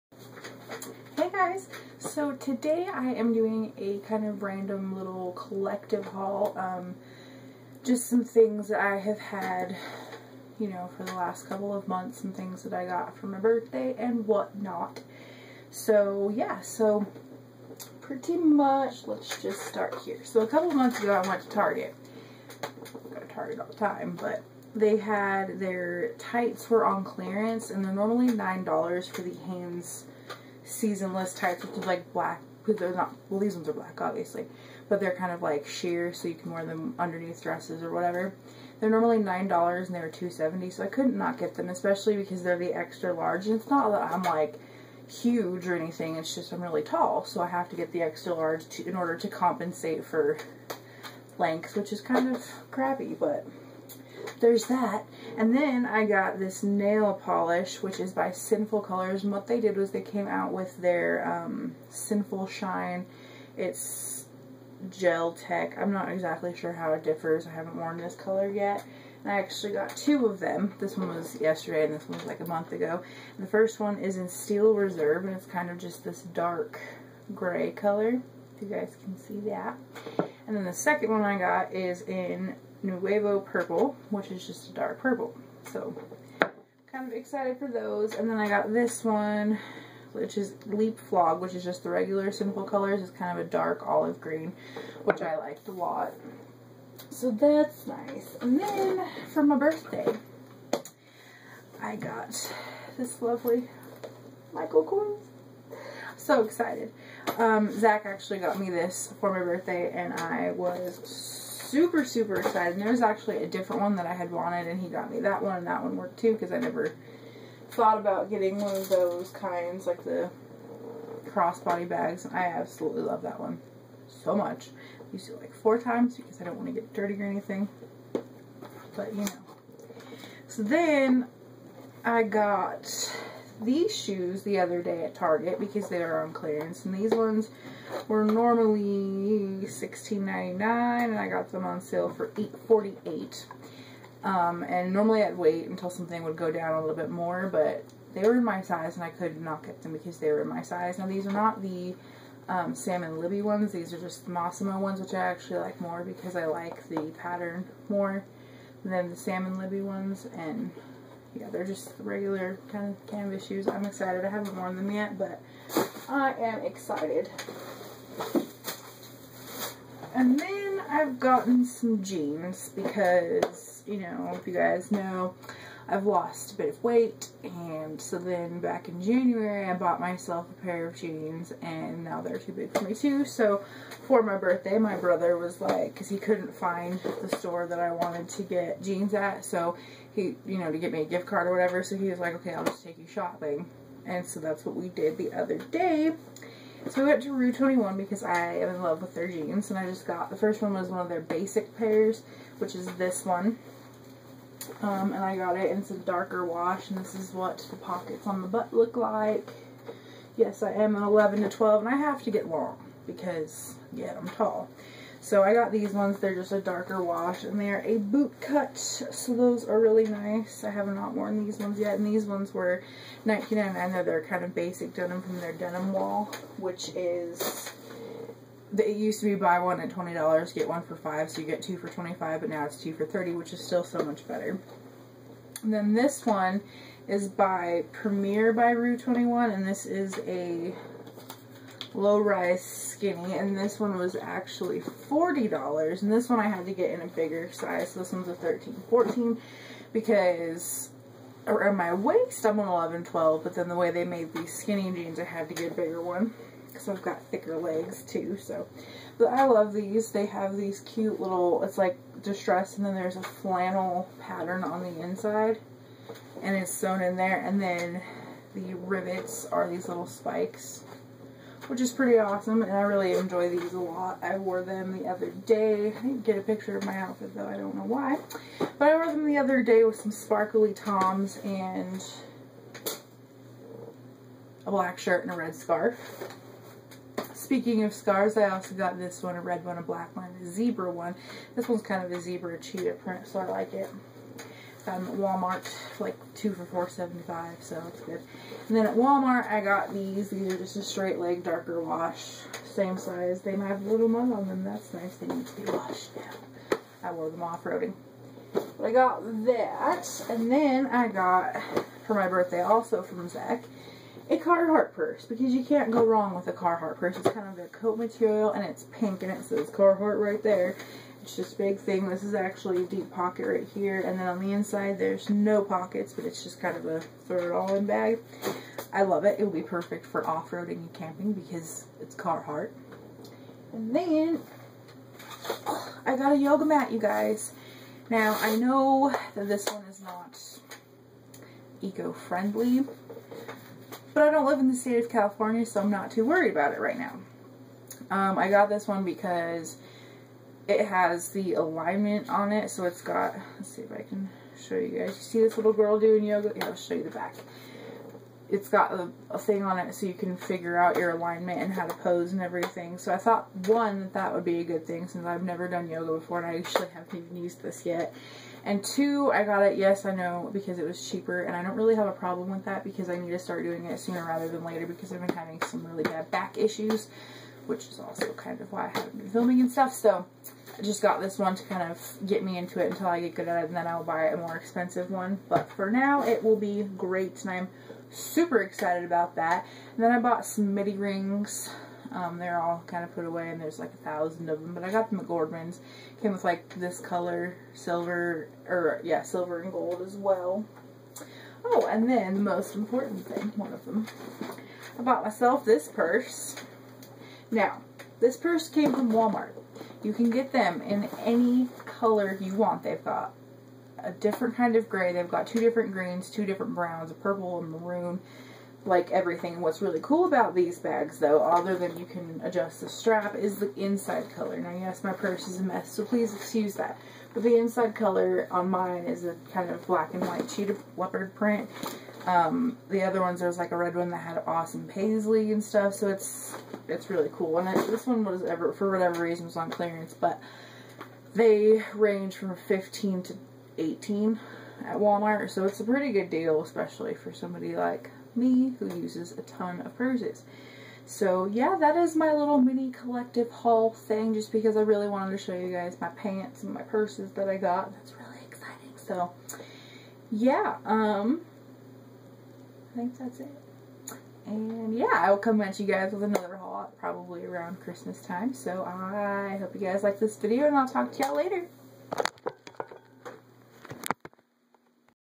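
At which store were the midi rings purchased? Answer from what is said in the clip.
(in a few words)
Gordman's.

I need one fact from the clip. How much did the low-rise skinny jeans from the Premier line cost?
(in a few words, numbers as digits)
$40.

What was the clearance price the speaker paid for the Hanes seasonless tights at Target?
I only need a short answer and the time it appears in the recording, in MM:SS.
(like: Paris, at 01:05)
$2.70, at 00:40.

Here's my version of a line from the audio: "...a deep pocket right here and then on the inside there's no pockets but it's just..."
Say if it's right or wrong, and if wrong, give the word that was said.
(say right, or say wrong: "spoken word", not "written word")
right.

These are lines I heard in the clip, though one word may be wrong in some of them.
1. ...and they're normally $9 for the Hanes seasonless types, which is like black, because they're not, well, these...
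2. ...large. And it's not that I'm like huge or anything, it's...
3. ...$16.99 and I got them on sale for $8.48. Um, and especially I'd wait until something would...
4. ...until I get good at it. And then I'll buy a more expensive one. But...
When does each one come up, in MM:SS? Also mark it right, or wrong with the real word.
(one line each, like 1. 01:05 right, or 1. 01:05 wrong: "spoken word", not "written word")
1. 00:27 right
2. 00:43 right
3. 02:19 wrong: "normally", not "especially"
4. 06:22 right.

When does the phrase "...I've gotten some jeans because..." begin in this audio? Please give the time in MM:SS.
02:50.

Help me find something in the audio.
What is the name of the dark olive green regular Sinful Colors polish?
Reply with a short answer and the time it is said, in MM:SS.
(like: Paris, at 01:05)
Leap Flog, at 01:30.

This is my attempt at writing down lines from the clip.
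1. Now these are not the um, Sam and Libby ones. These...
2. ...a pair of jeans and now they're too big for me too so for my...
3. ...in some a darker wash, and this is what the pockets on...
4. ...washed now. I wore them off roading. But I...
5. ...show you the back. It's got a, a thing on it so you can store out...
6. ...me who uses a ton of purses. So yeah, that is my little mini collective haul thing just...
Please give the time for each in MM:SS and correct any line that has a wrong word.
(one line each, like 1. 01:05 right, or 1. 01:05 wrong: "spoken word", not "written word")
1. 02:30 right
2. 03:00 right
3. 03:25 right
4. 05:05 right
5. 05:56 wrong: "figure", not "store"
6. 07:28 right.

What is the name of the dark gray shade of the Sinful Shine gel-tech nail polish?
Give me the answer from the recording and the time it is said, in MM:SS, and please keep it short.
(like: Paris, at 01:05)
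Steel Reserve, at 01:14.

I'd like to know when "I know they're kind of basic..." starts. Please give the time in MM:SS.
03:43.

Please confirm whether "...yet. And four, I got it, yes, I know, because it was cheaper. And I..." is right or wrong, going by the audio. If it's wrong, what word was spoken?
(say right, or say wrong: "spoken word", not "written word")
wrong: "two", not "four".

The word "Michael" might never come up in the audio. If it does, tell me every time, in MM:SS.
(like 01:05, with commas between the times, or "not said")
01:44.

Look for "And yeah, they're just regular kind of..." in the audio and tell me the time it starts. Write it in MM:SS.
02:40.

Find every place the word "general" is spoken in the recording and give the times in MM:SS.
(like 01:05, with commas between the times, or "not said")
not said.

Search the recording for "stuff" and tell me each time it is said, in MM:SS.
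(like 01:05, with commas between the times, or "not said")
06:19, 07:15.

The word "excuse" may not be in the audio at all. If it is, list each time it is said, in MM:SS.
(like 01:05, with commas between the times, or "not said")
07:06.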